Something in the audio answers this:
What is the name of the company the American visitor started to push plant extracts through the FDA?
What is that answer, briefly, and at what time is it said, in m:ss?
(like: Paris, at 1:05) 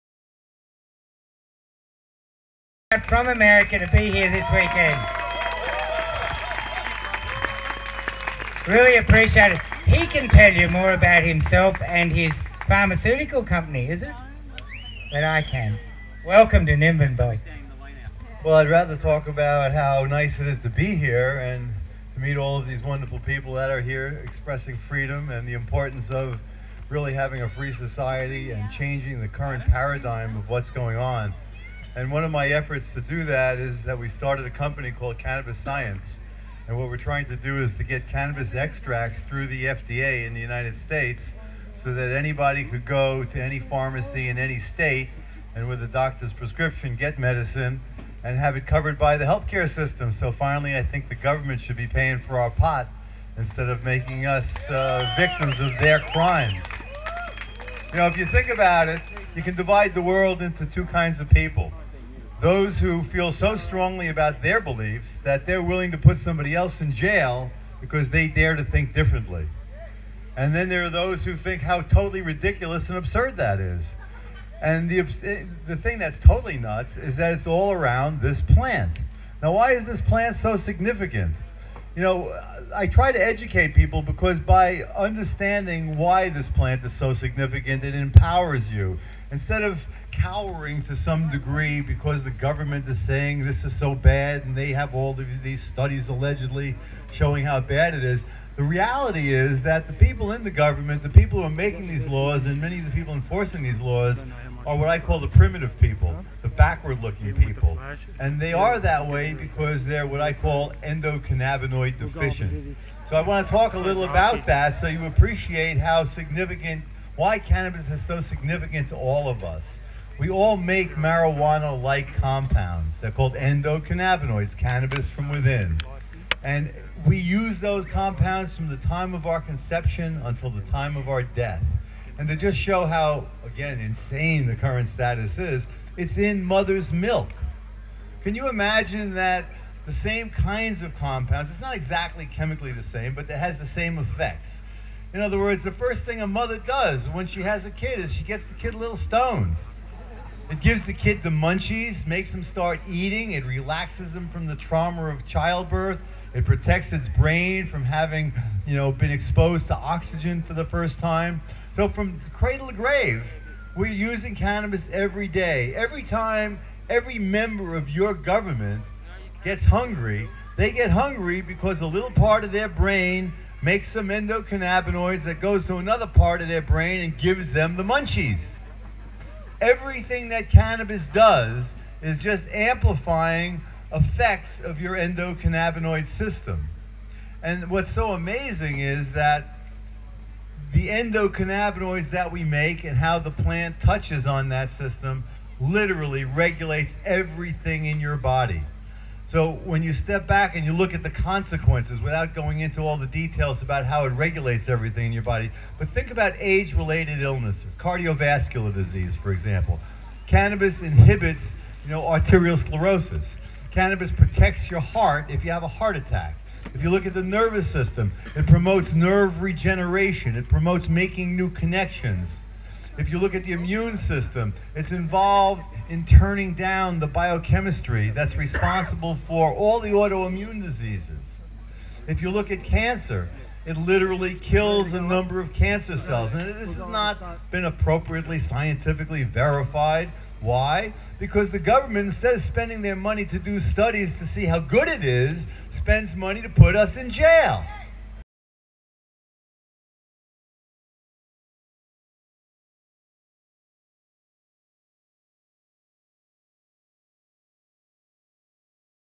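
Cannabis Science, at 0:35.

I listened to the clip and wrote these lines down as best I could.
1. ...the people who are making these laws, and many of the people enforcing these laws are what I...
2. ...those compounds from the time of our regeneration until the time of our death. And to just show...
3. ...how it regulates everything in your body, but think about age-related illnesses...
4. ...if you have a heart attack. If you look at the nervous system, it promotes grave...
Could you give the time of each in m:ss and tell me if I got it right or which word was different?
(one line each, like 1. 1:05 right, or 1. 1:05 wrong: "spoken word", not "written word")
1. 1:41 right
2. 2:07 wrong: "conception", not "regeneration"
3. 3:23 right
4. 3:35 wrong: "nerve", not "grave".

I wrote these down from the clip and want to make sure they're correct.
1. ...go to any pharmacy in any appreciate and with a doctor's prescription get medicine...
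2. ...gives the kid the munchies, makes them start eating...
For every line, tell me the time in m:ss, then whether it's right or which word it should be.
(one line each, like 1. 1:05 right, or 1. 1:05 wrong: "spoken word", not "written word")
1. 0:42 wrong: "state", not "appreciate"
2. 2:30 right.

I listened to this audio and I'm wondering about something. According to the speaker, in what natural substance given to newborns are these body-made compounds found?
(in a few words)
mother's milk.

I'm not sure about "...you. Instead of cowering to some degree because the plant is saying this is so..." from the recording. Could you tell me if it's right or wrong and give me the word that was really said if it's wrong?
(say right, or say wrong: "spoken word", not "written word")
wrong: "government", not "plant".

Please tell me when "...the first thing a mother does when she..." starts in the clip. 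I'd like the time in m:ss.
2:25.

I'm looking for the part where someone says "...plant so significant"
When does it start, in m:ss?
1:20.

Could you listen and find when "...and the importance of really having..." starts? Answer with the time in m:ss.
0:25.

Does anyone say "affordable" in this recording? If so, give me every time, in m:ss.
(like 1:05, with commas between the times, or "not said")
not said.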